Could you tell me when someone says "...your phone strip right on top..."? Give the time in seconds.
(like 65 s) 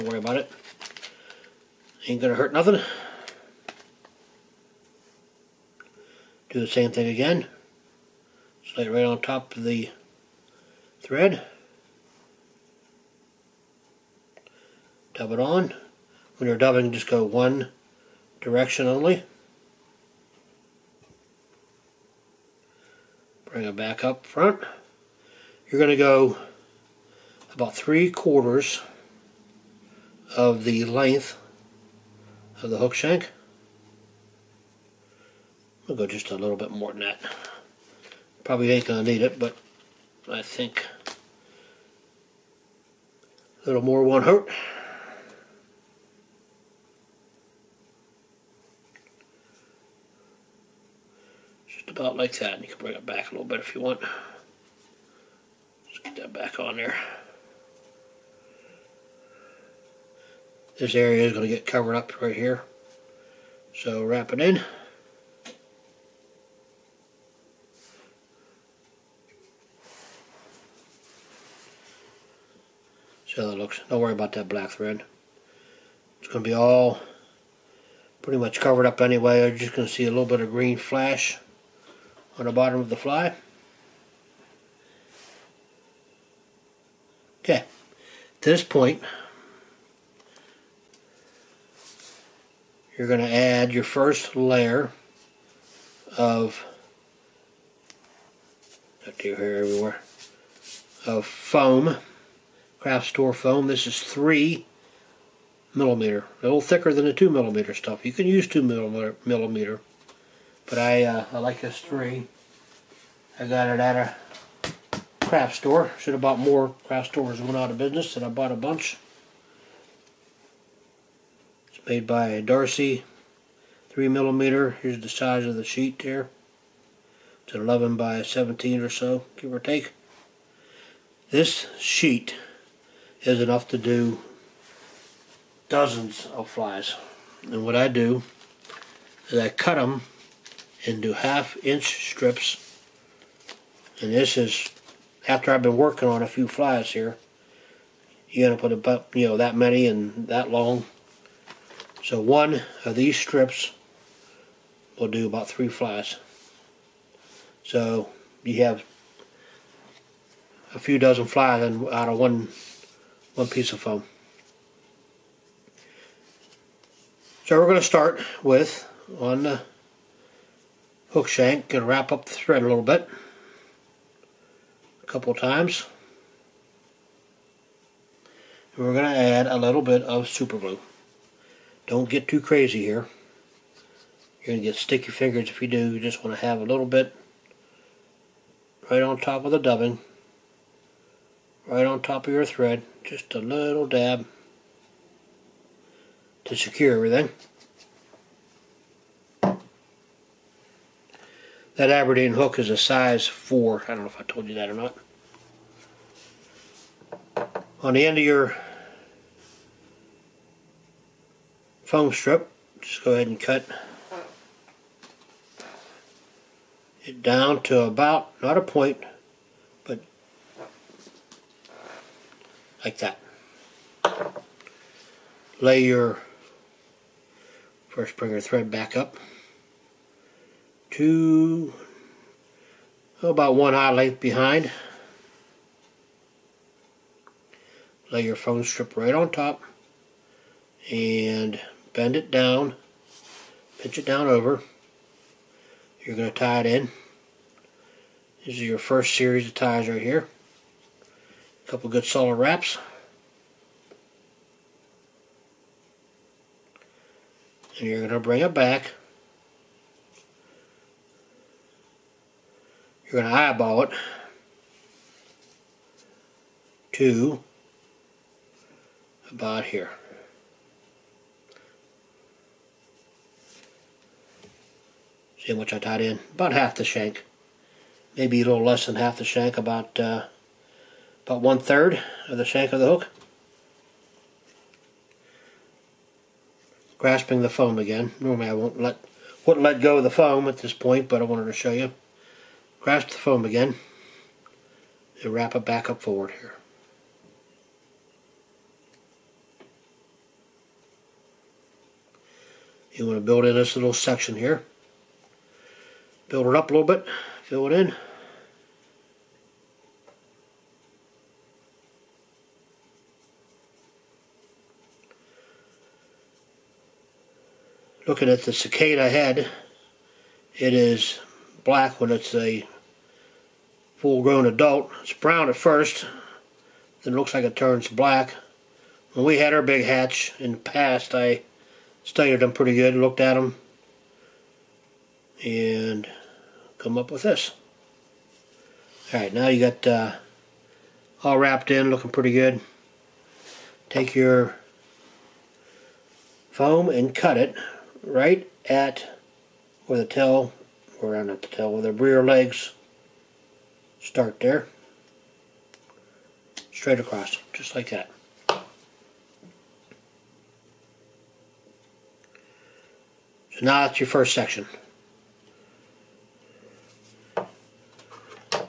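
238 s.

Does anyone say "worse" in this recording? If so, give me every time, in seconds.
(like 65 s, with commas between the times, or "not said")
not said.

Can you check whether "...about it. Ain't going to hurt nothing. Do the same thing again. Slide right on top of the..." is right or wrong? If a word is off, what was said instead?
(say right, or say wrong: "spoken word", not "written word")
right.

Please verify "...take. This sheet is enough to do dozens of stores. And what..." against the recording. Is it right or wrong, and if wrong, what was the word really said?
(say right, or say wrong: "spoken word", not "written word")
wrong: "flies", not "stores".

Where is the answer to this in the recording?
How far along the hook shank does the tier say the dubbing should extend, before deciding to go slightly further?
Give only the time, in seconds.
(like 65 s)
27 s.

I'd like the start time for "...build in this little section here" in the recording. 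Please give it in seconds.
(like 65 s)
303 s.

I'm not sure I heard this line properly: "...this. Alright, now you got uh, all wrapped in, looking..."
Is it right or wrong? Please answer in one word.
right.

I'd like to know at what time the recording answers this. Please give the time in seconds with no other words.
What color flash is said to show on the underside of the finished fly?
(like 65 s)
80 s.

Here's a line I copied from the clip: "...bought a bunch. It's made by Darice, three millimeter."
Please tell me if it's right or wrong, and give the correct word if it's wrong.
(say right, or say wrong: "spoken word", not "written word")
right.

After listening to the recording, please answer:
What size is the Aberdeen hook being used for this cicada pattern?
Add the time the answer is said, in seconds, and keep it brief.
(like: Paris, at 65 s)
4, at 202 s.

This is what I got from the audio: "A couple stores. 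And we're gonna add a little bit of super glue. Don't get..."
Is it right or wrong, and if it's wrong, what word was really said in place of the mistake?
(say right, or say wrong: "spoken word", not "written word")
wrong: "times", not "stores".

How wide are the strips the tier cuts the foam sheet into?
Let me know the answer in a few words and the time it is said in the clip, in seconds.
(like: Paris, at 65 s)
half inch, at 141 s.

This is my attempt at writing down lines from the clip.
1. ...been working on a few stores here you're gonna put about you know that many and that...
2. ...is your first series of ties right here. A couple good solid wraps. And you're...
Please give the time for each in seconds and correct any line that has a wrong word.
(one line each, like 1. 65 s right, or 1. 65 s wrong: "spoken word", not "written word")
1. 145 s wrong: "flies", not "stores"
2. 248 s right.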